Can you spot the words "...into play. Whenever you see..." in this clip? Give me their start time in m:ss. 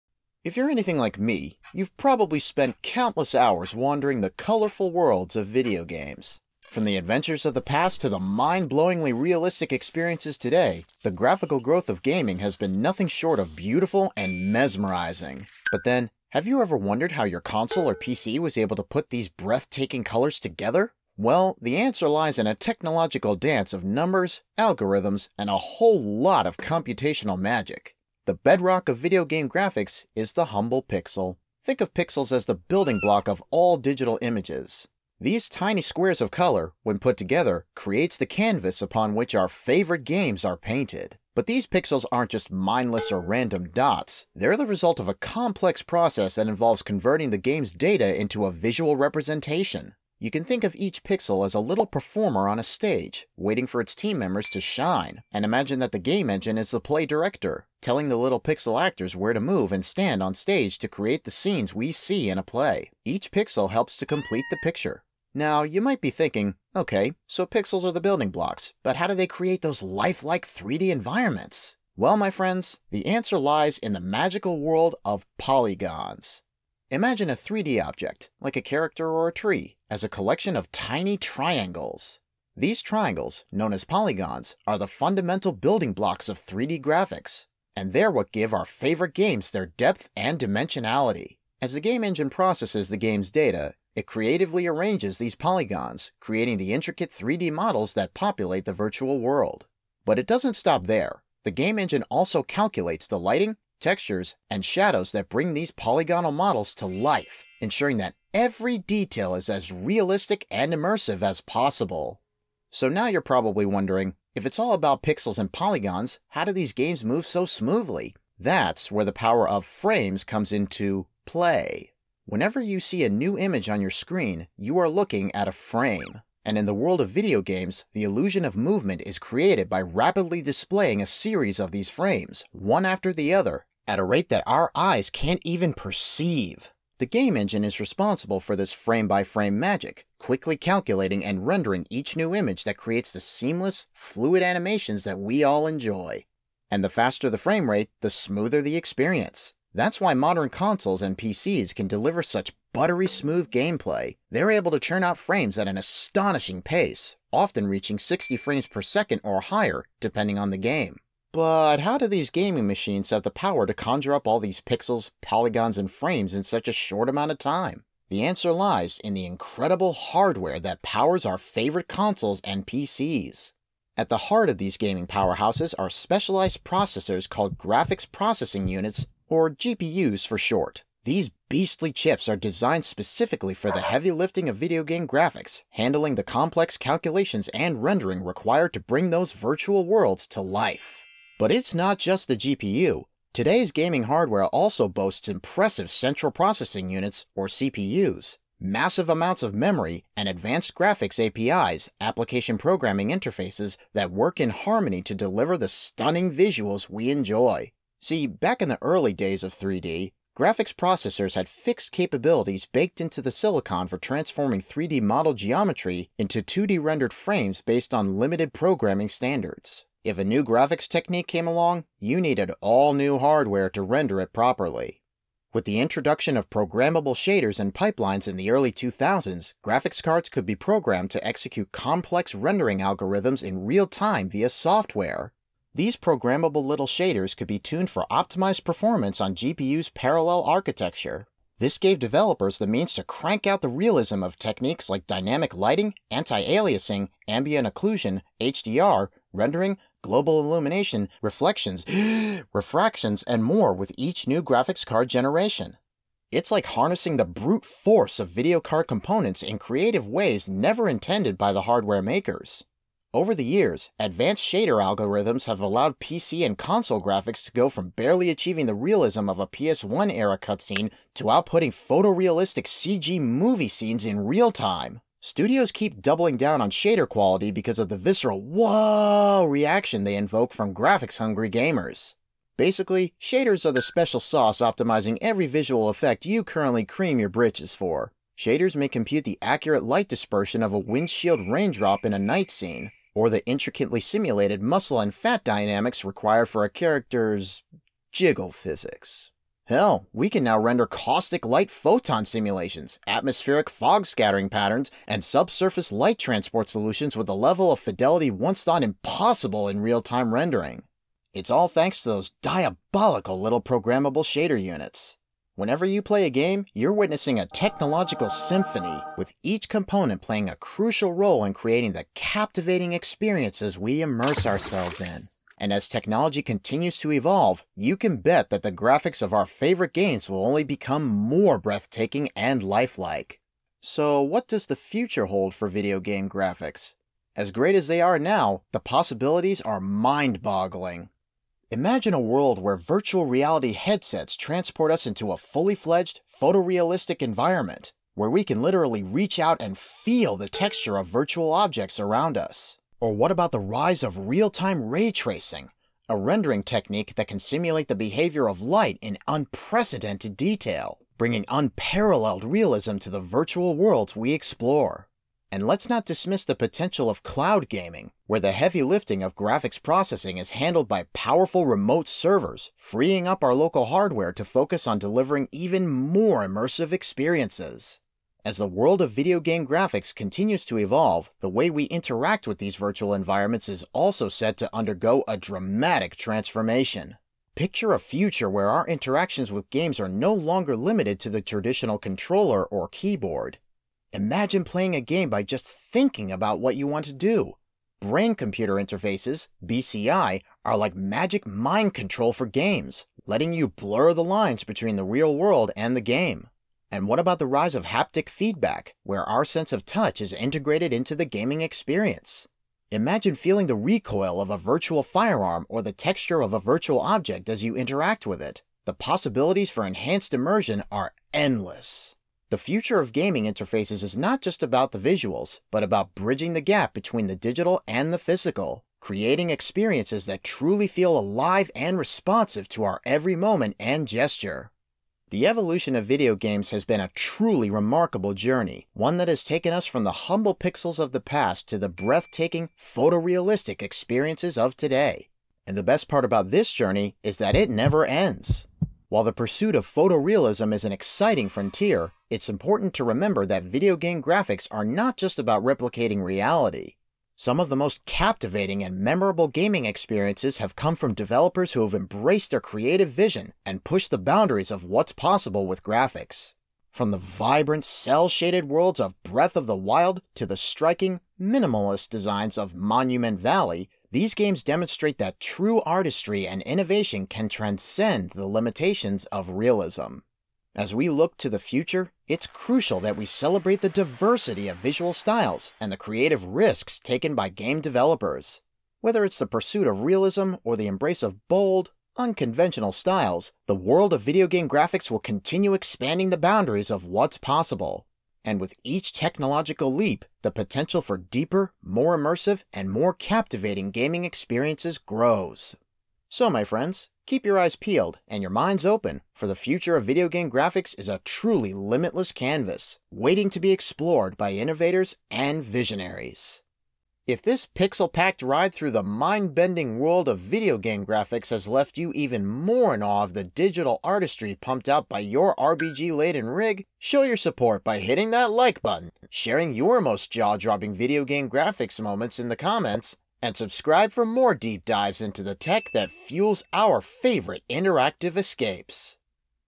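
2:00.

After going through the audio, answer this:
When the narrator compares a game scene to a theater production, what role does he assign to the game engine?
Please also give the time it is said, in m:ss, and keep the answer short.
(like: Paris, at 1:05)
play director, at 0:56.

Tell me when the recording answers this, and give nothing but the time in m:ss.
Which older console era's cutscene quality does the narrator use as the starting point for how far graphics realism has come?
4:29.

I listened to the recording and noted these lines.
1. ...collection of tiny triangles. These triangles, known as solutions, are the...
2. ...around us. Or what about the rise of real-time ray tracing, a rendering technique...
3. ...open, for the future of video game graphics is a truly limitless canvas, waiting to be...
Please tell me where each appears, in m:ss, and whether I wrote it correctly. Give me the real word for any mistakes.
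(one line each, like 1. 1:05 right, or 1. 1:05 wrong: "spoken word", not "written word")
1. 1:20 wrong: "polygons", not "solutions"
2. 5:51 right
3. 8:28 right.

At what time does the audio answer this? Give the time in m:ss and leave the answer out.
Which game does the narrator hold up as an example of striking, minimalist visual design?
7:52.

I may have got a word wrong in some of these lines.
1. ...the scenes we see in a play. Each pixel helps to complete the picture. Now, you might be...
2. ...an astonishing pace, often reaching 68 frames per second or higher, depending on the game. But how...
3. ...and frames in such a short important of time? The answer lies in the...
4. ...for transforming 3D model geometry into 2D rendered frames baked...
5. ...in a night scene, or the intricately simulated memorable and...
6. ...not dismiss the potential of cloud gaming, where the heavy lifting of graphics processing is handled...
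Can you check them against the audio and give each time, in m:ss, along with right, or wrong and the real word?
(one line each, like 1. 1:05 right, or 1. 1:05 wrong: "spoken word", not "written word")
1. 1:01 right
2. 2:35 wrong: "60", not "68"
3. 2:45 wrong: "amount", not "important"
4. 3:33 wrong: "based", not "baked"
5. 4:52 wrong: "muscle", not "memorable"
6. 6:05 right.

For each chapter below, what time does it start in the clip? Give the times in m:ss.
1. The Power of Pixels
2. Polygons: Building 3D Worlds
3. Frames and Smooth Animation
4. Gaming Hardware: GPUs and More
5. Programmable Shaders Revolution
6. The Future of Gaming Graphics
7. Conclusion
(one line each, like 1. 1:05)
1. 0:33
2. 1:16
3. 2:06
4. 2:54
5. 3:46
6. 5:35
7. 8:30.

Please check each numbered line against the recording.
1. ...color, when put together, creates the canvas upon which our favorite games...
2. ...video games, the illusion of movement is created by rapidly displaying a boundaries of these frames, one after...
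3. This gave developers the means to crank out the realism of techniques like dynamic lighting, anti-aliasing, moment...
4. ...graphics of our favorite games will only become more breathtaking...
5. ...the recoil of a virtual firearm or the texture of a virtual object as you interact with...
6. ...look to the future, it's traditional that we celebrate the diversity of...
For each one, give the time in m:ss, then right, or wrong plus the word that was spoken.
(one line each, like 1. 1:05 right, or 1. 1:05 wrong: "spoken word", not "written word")
1. 0:36 right
2. 2:07 wrong: "series", not "boundaries"
3. 4:01 wrong: "ambient", not "moment"
4. 5:28 right
5. 6:53 right
6. 8:01 wrong: "crucial", not "traditional".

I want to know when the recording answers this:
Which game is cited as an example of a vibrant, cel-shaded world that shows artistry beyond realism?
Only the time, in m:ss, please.
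7:49.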